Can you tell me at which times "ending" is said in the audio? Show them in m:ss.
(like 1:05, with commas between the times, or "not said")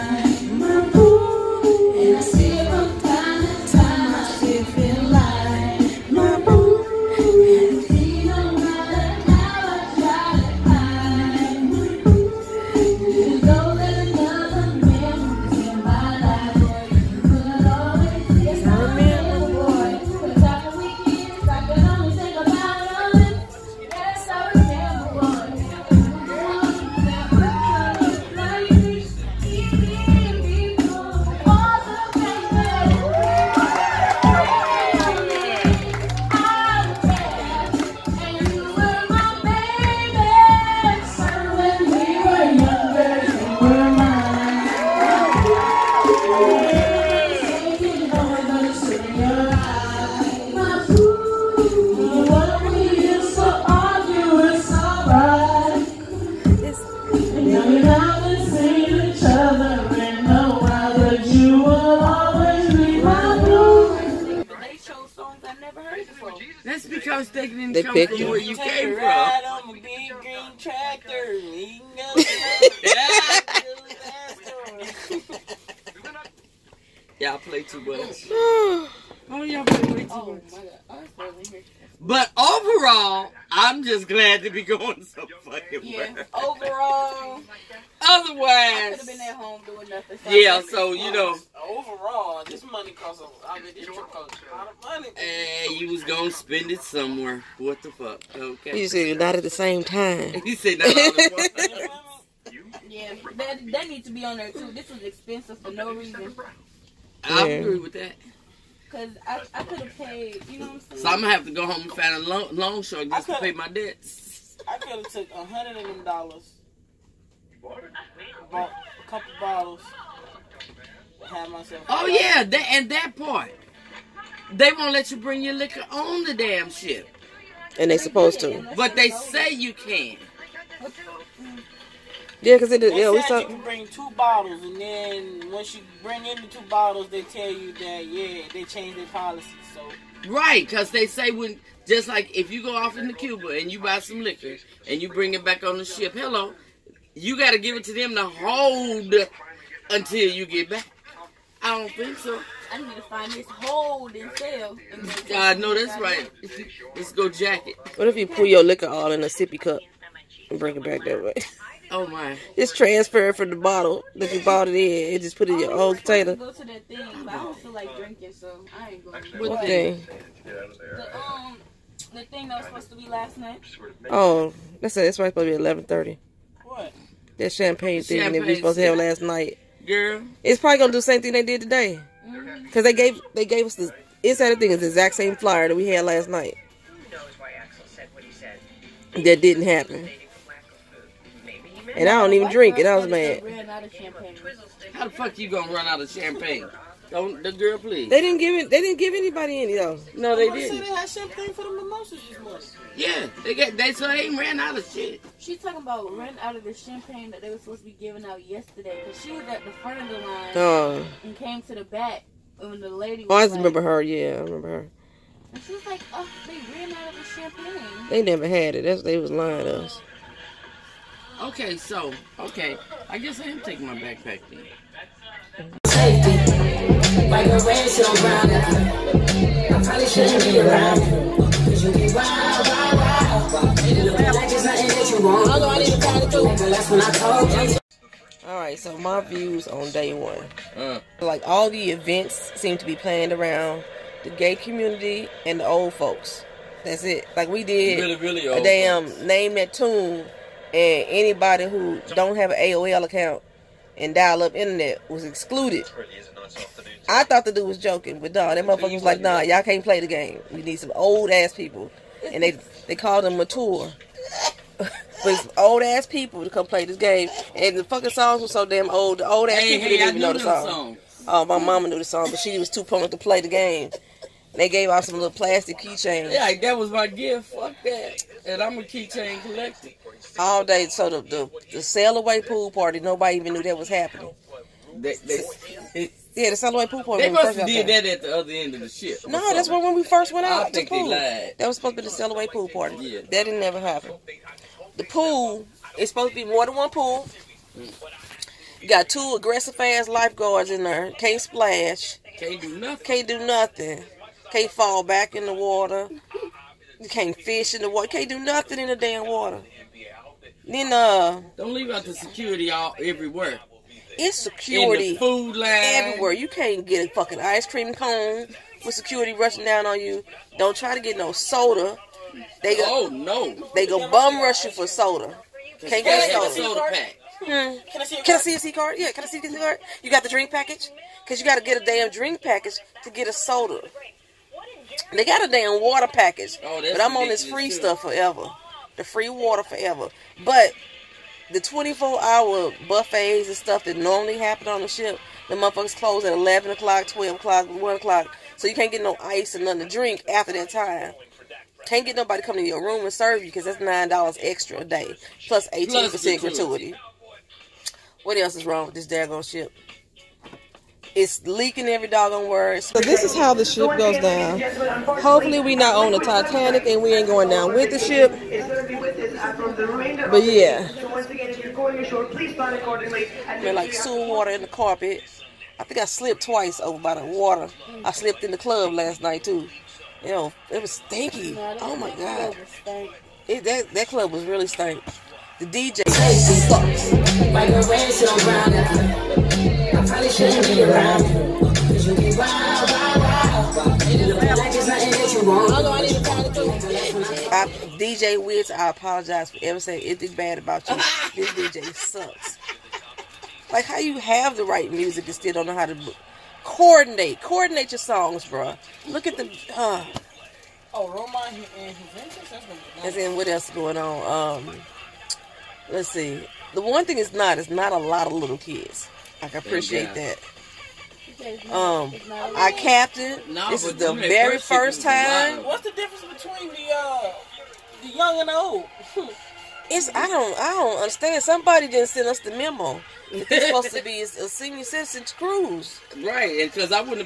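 not said.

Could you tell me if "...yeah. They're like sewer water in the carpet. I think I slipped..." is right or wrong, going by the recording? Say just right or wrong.
right.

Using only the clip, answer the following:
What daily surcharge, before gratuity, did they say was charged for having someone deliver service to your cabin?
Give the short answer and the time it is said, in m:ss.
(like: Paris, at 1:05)
$9, at 5:53.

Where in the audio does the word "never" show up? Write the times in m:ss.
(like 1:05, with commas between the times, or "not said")
3:38, 4:53.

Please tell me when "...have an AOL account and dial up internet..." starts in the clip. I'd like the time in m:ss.
4:12.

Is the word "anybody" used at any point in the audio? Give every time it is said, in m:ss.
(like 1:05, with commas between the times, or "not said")
3:19, 4:11.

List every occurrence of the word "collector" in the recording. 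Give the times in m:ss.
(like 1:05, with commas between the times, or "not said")
4:39.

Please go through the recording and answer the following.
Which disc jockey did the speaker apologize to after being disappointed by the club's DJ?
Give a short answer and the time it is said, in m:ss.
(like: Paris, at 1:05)
DJ Wiz, at 6:37.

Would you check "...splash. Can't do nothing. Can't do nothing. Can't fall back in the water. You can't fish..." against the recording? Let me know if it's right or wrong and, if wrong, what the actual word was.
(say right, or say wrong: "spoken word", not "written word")
right.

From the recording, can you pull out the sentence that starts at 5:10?
Then uh Don't leave out the security all everywhere.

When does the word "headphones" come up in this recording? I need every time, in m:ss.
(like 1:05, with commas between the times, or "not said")
not said.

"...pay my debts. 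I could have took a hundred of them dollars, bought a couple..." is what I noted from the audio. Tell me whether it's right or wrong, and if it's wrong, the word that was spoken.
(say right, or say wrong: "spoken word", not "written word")
right.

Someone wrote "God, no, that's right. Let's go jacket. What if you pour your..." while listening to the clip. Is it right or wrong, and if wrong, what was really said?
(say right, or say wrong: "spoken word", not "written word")
right.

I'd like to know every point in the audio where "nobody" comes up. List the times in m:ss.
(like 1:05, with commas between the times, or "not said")
4:42, 5:52.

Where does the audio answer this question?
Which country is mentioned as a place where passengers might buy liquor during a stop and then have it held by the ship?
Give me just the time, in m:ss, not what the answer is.
2:23.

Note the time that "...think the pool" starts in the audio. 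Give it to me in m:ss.
4:50.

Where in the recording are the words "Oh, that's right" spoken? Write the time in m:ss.
2:54.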